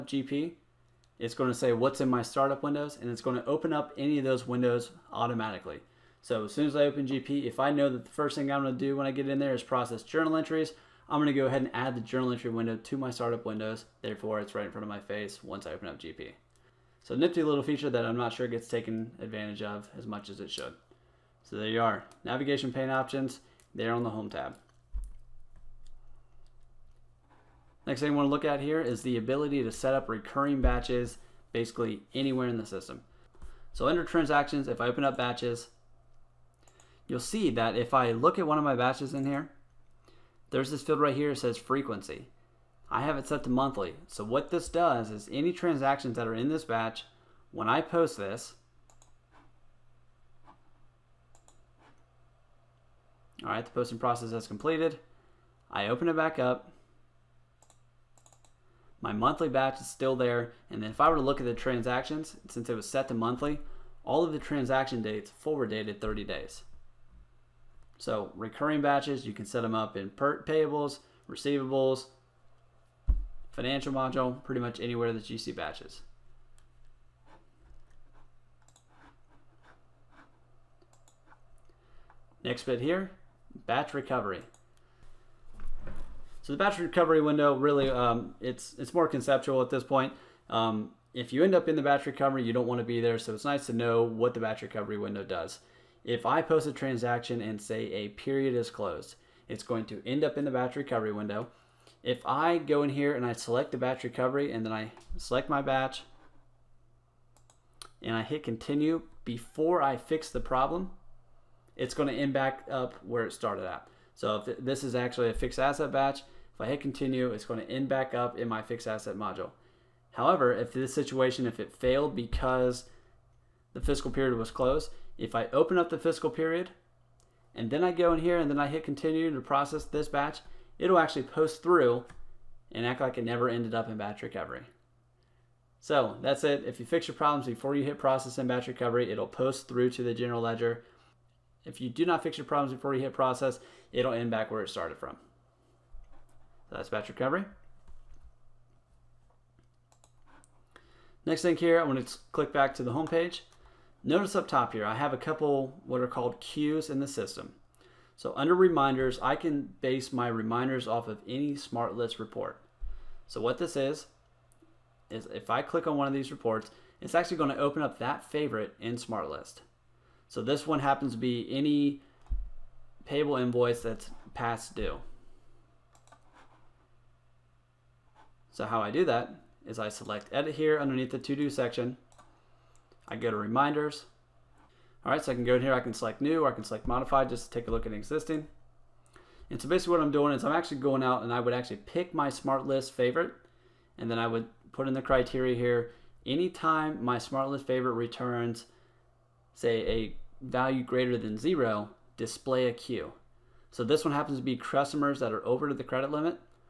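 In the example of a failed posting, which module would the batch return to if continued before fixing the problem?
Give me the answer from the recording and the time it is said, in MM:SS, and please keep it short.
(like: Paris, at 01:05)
Fixed asset module, at 01:58.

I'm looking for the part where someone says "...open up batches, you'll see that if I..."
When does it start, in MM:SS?
00:34.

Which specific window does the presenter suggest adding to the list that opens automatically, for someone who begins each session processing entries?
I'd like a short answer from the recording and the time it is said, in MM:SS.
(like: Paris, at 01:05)
Journal entry window, at 00:11.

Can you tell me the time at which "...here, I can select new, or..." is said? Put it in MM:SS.
03:05.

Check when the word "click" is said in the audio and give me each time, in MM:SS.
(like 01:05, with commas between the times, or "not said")
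02:32, 02:45.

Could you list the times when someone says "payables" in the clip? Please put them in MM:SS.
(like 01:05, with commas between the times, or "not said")
01:10, 02:53.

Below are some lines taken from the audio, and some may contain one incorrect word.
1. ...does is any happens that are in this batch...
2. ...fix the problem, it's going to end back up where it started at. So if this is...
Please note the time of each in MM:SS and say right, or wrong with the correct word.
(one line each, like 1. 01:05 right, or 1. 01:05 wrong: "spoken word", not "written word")
1. 00:44 wrong: "transactions", not "happens"
2. 01:49 right.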